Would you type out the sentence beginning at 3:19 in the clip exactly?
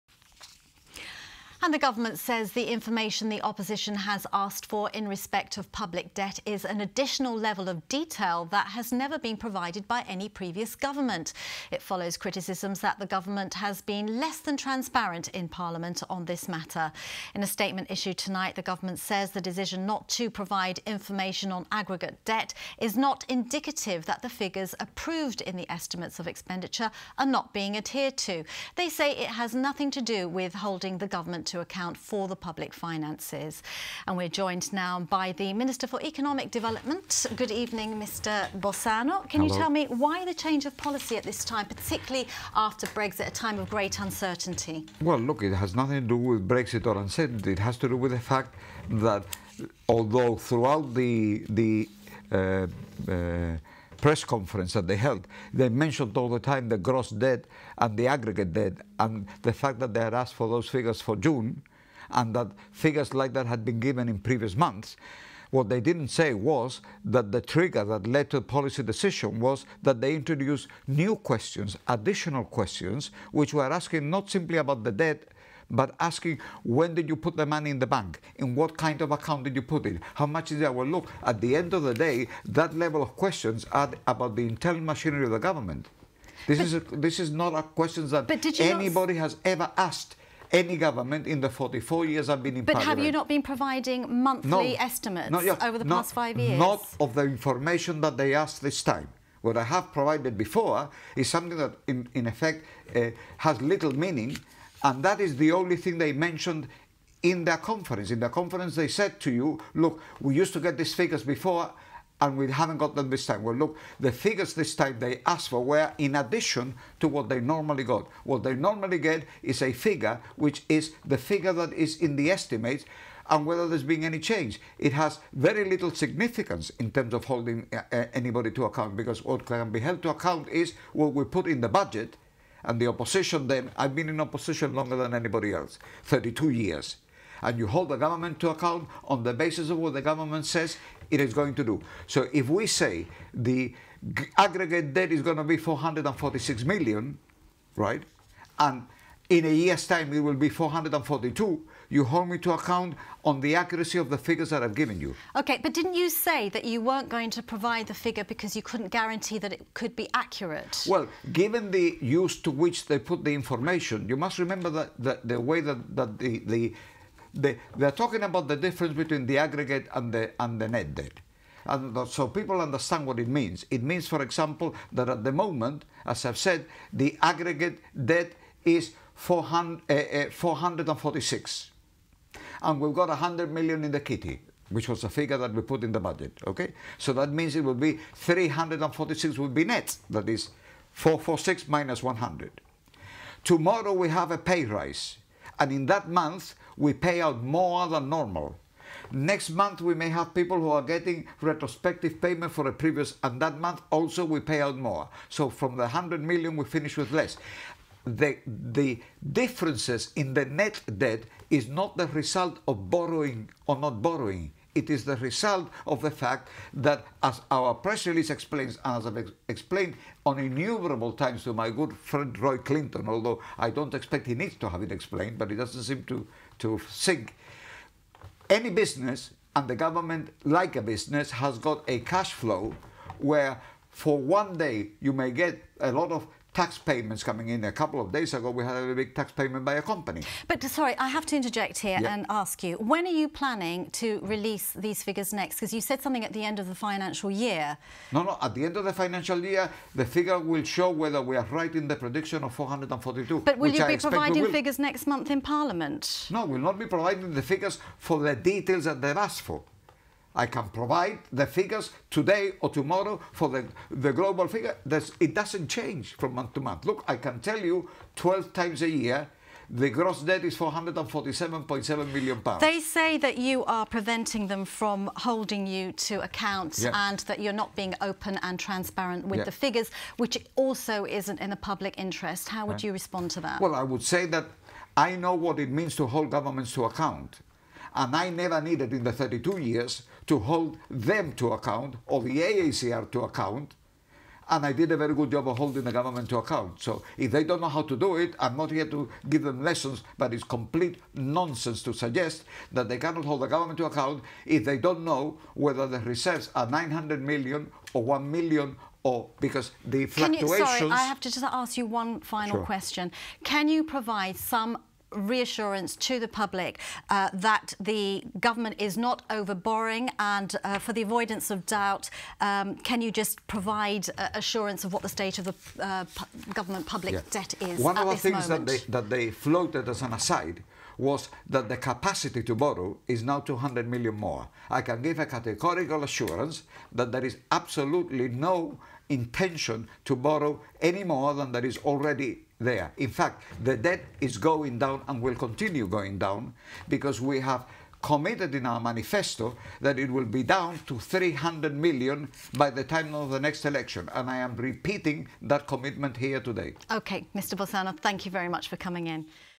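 Next month we may have people who are getting retrospective payment for a previous, and that month also we pay out more.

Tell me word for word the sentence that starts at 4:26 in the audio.
Look, I can tell you 12 times a year the gross debt is 447.7 million pounds.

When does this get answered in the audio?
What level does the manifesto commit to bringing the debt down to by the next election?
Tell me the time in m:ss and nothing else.
5:50.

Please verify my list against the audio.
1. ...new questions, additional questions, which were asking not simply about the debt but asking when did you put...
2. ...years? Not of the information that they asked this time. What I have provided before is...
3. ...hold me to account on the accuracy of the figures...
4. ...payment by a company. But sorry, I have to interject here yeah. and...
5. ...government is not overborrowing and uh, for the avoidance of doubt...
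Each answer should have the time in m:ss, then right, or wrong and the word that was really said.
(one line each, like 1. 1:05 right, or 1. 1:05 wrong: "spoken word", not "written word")
1. 1:10 right
2. 1:36 right
3. 2:32 right
4. 3:59 right
5. 5:18 right.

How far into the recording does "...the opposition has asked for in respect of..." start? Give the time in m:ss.
0:03.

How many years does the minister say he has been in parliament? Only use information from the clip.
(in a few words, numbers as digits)
44.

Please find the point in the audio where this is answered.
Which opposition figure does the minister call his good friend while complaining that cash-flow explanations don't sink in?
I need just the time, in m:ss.
3:42.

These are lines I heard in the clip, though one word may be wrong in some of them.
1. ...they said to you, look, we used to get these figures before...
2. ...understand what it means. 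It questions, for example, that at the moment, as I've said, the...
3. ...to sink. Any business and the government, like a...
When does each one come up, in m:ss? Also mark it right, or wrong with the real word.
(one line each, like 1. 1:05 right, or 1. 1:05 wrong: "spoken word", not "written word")
1. 1:48 right
2. 2:52 wrong: "means", not "questions"
3. 3:46 right.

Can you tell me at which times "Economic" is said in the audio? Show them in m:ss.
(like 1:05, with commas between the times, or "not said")
0:36.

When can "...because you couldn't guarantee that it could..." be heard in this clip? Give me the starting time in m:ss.
2:38.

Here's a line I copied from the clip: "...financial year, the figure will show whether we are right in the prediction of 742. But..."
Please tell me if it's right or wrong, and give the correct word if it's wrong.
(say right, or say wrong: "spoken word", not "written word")
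wrong: "442", not "742".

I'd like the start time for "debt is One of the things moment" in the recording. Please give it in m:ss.
5:27.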